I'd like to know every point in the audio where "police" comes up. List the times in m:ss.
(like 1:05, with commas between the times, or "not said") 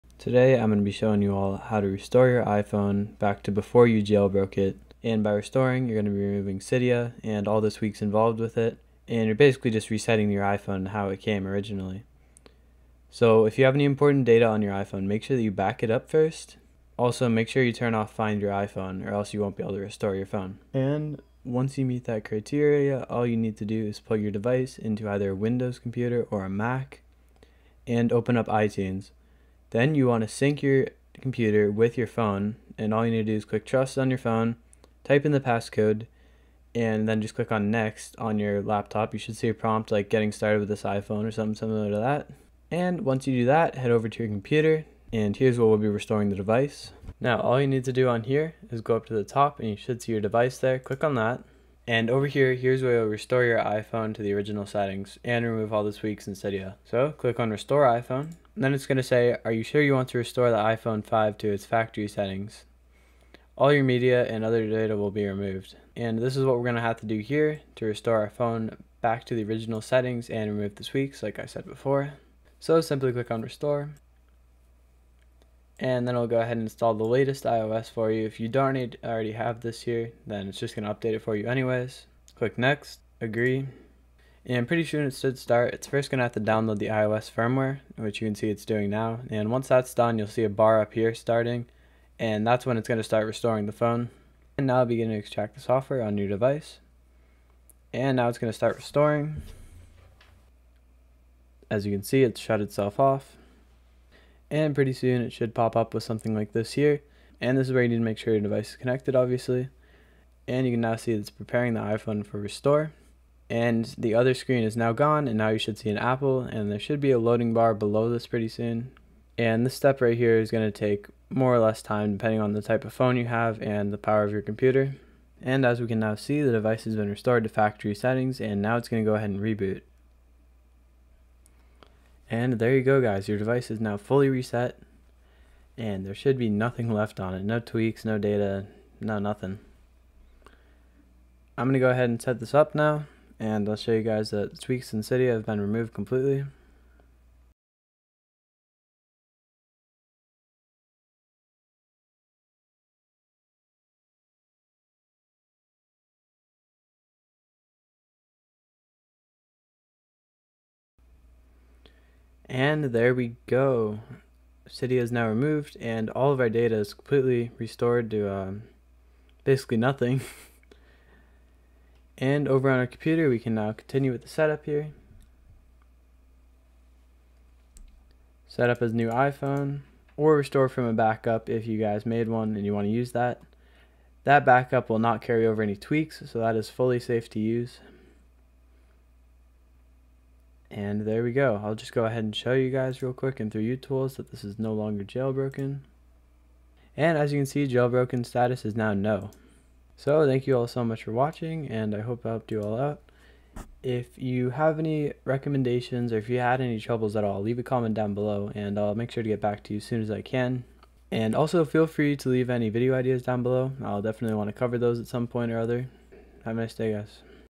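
not said.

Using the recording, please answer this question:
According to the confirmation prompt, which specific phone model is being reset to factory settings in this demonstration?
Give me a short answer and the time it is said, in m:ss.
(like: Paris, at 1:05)
iPhone 5, at 1:00.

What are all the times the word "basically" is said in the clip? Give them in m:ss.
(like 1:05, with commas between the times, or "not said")
0:09, 2:49.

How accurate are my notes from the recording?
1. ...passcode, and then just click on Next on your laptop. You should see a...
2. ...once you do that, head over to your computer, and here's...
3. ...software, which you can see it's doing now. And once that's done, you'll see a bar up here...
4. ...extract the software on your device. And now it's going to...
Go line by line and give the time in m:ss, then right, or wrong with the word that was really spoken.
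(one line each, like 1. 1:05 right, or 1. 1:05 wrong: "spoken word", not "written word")
1. 0:35 right
2. 0:43 right
3. 1:27 wrong: "firmware", not "software"
4. 1:35 right.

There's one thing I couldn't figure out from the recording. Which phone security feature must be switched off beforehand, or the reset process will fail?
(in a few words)
Find Your iPhone.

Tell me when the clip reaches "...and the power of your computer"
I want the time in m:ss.
2:03.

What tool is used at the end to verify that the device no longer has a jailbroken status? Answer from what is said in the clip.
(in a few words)
utools.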